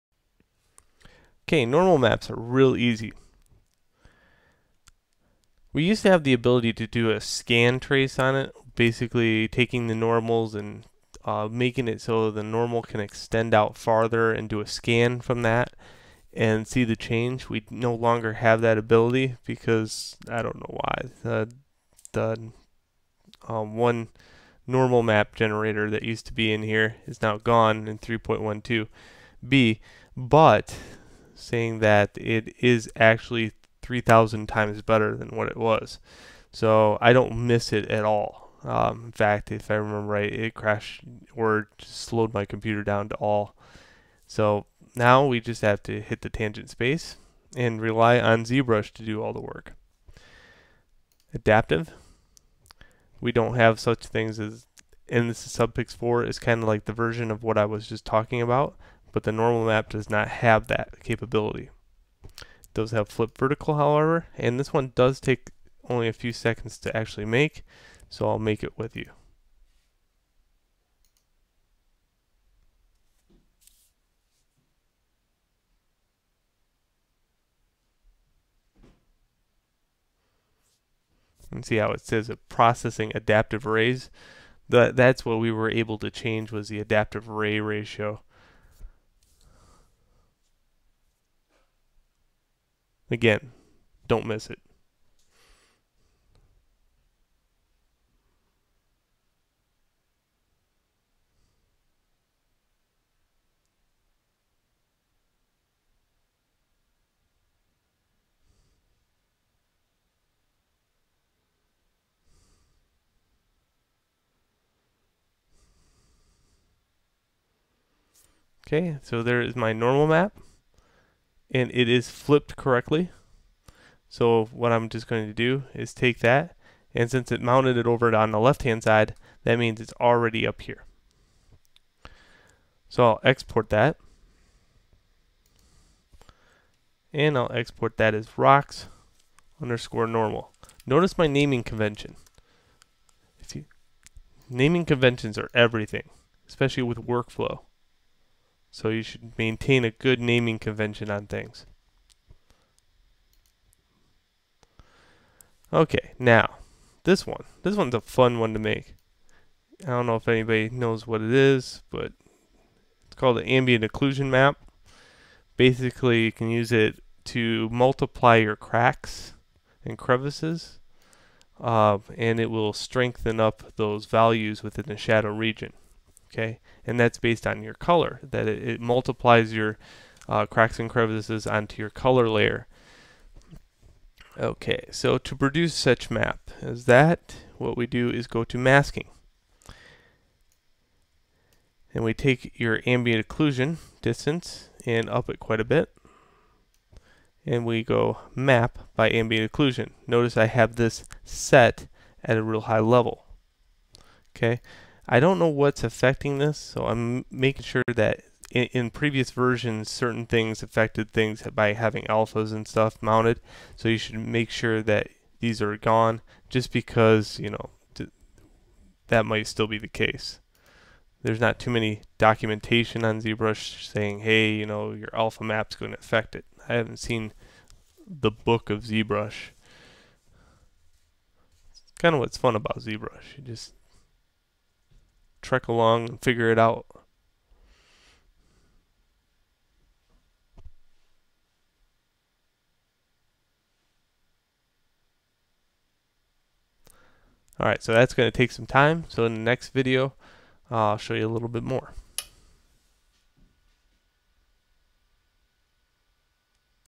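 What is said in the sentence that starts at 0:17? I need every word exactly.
We no longer have that ability because I don't know why.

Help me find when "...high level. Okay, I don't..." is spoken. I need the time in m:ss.
3:22.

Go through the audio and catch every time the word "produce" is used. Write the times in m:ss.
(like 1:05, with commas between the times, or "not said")
3:05.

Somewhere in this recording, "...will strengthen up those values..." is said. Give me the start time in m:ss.
2:52.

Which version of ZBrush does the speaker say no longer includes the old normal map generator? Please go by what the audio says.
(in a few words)
3.12b.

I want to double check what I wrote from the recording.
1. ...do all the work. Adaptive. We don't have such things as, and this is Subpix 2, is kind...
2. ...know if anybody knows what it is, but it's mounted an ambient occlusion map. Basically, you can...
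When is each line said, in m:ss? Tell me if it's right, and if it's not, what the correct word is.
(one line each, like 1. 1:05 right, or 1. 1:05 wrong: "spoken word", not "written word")
1. 0:49 wrong: "4", not "2"
2. 2:40 wrong: "called", not "mounted".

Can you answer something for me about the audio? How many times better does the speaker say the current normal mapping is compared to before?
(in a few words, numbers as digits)
3,000.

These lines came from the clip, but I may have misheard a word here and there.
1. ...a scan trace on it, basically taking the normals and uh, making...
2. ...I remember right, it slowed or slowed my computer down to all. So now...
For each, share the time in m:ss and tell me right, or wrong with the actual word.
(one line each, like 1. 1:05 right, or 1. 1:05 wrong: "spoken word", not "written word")
1. 0:07 right
2. 0:39 wrong: "crashed", not "slowed".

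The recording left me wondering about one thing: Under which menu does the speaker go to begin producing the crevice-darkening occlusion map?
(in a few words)
Masking.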